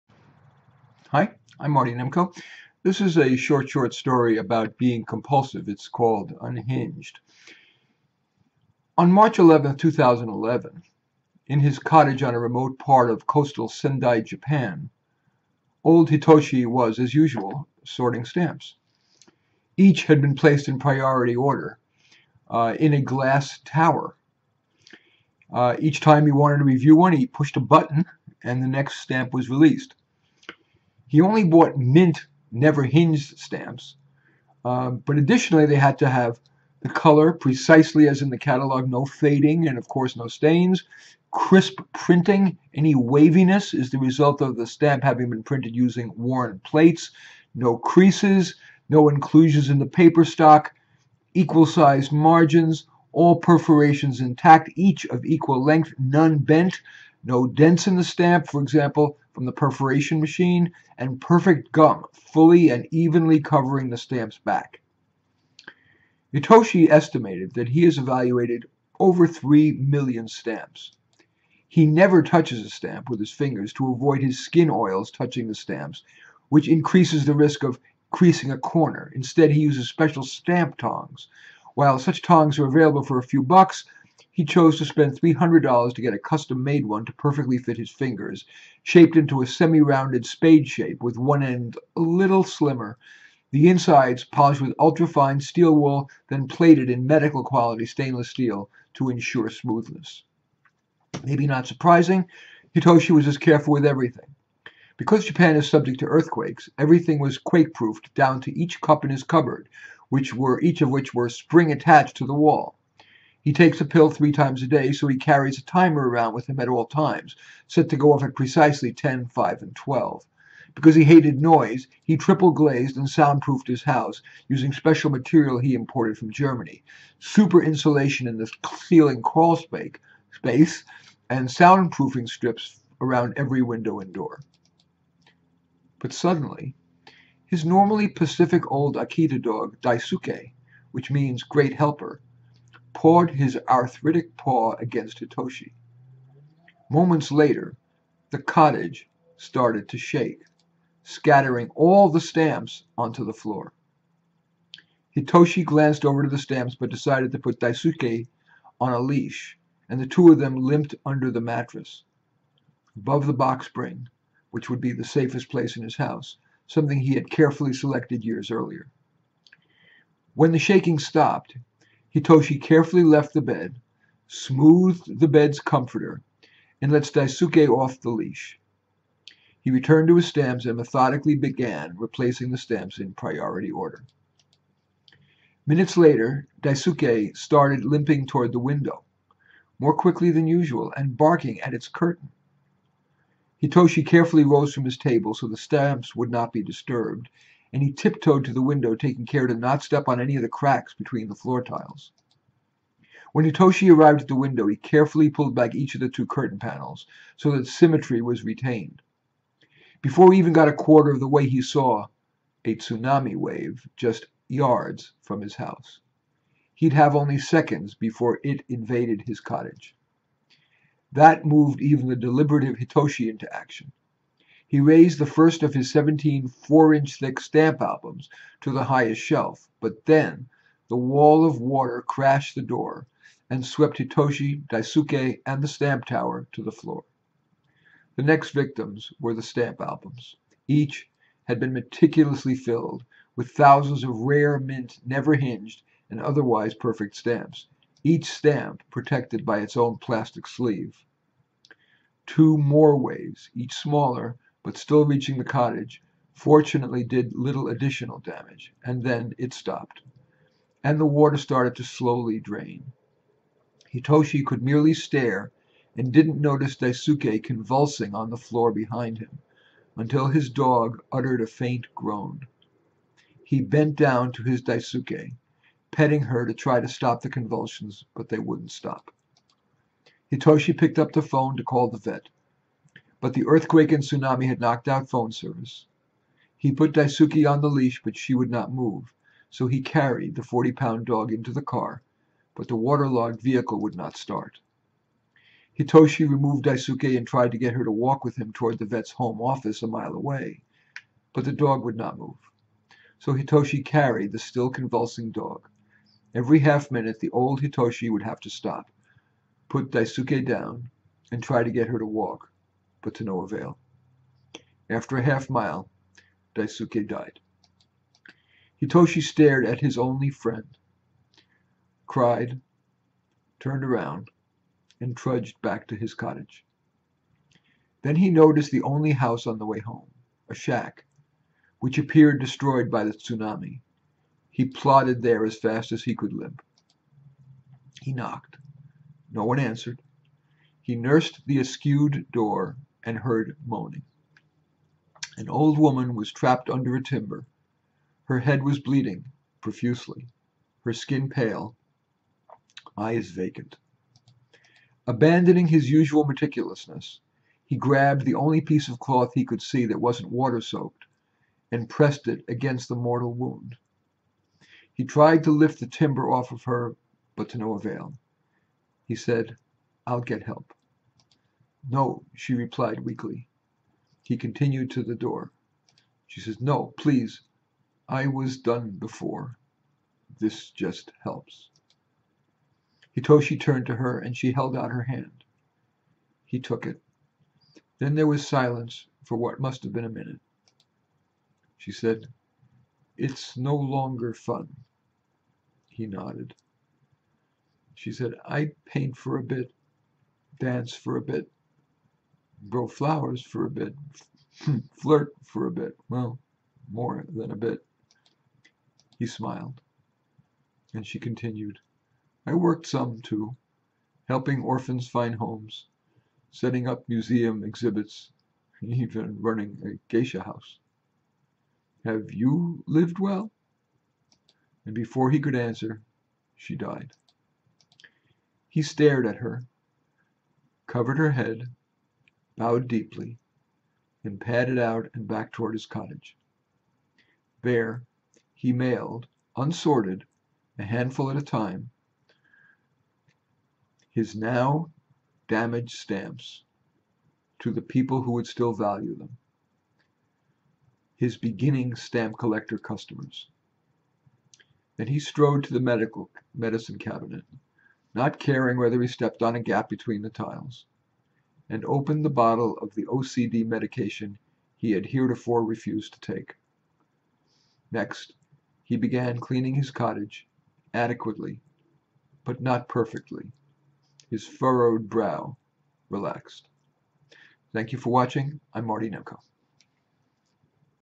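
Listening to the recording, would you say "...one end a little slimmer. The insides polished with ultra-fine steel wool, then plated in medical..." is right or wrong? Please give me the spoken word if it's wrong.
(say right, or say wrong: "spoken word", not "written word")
right.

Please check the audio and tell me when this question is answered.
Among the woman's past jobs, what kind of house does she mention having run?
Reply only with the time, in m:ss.
7:00.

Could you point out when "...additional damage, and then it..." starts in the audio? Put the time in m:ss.
4:17.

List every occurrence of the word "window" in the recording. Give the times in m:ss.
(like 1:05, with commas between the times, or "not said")
2:13, 3:08, 3:18, 3:24.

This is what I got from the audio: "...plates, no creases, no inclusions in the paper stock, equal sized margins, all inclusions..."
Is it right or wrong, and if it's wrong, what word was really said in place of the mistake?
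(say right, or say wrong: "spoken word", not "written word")
wrong: "perforations", not "inclusions".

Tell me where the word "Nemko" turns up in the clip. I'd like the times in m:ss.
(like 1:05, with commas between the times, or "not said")
0:01, 7:59.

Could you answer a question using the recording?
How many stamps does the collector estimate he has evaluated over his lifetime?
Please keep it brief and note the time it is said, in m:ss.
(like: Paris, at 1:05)
over 3 million, at 1:08.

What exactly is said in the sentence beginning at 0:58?
For example, from the perforation machine and perfect gum, fully and evenly covering the stamp's back.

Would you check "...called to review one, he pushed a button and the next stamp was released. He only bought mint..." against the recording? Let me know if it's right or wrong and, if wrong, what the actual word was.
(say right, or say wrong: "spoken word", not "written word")
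wrong: "wanted", not "called".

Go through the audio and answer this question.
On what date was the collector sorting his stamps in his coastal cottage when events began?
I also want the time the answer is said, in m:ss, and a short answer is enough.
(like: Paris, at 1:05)
March 11, 2011, at 0:09.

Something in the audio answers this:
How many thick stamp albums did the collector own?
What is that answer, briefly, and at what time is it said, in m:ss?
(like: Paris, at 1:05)
17, at 3:45.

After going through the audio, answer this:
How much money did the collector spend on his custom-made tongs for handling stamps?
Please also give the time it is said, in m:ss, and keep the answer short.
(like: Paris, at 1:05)
$300, at 1:25.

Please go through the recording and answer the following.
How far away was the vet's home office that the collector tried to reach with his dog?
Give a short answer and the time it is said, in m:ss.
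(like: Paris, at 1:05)
a mile, at 4:59.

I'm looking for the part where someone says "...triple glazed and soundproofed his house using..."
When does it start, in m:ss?
2:02.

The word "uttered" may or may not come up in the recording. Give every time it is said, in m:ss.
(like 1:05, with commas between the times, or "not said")
4:31.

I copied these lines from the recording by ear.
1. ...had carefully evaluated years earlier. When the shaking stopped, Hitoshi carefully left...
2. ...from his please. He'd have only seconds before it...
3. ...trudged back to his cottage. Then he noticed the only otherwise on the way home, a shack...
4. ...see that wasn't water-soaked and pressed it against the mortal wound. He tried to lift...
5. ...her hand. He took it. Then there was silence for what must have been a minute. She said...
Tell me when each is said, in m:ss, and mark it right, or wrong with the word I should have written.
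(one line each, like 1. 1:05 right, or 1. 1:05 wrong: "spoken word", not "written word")
1. 2:47 wrong: "selected", not "evaluated"
2. 3:35 wrong: "house", not "please"
3. 5:25 wrong: "house", not "otherwise"
4. 5:59 right
5. 6:24 right.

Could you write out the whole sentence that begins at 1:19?
Instead, he uses special stamp tongs.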